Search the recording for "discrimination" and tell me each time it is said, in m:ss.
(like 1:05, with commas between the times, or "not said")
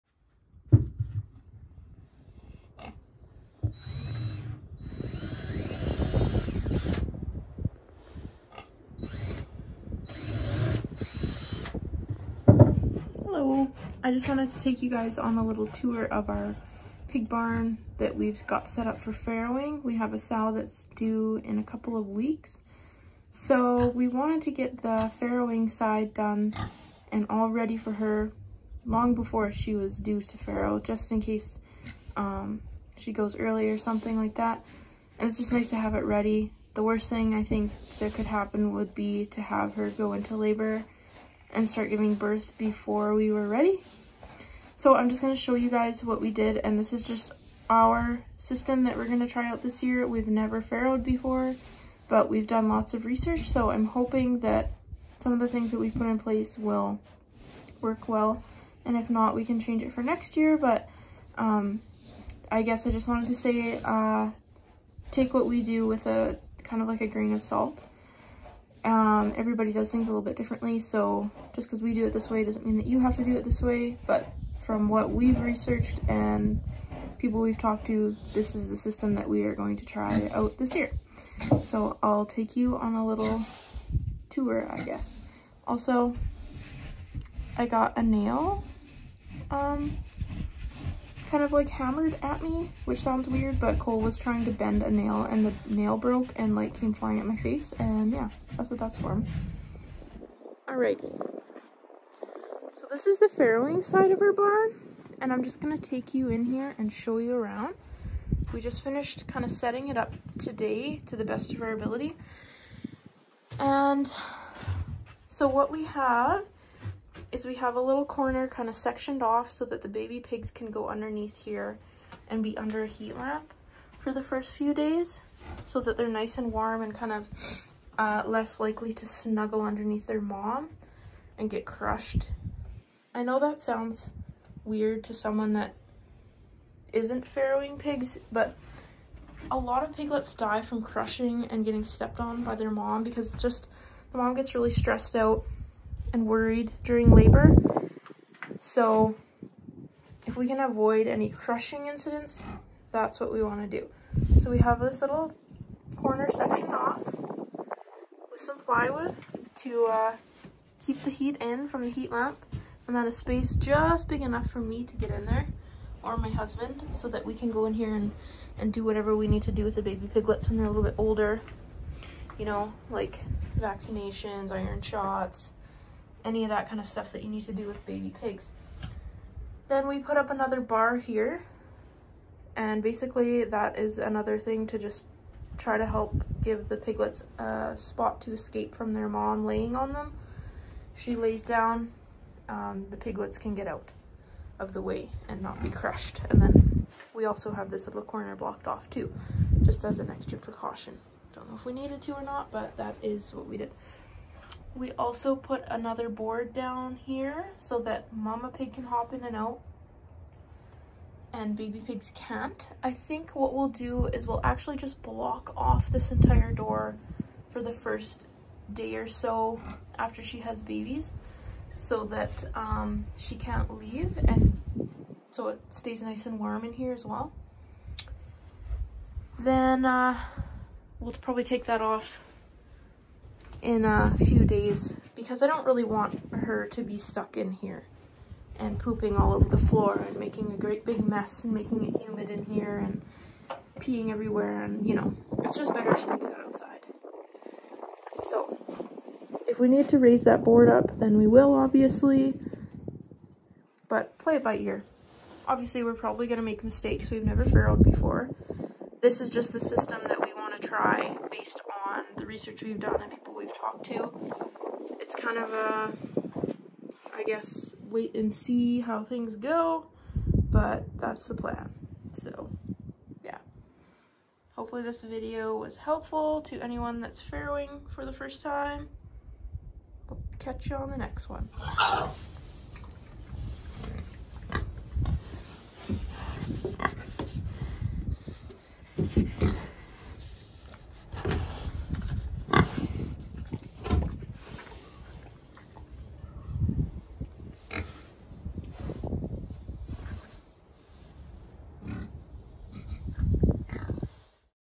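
not said.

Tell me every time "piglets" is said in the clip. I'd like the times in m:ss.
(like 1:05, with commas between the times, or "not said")
2:19, 2:50, 3:06, 3:12.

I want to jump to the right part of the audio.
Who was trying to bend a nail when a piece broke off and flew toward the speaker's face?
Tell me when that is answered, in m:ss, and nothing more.
1:33.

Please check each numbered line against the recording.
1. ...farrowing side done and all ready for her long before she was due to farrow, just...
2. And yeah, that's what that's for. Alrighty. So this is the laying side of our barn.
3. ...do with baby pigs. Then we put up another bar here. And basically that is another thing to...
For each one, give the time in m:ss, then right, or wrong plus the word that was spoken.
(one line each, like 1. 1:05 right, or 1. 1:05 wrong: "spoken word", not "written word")
1. 0:25 right
2. 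1:37 wrong: "farrowing", not "laying"
3. 2:57 right.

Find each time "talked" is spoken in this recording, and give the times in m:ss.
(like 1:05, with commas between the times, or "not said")
1:17, 4:23.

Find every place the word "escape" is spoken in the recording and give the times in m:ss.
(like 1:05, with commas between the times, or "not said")
3:08.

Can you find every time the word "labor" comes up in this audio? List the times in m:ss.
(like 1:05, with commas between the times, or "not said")
0:40, 2:27.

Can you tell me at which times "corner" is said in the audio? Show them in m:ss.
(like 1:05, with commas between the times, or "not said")
1:58, 2:35, 3:18.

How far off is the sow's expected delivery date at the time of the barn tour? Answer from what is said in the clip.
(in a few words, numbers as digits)
a couple of weeks.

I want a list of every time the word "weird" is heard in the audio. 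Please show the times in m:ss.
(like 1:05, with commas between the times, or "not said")
1:33, 2:14.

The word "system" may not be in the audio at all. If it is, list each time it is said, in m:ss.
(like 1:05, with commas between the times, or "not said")
0:48, 1:18, 4:19.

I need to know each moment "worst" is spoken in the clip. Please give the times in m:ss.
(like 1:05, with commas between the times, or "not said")
0:36.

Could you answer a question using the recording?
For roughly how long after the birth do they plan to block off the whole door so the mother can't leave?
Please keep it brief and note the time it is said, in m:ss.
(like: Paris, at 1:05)
the first day or so, at 3:37.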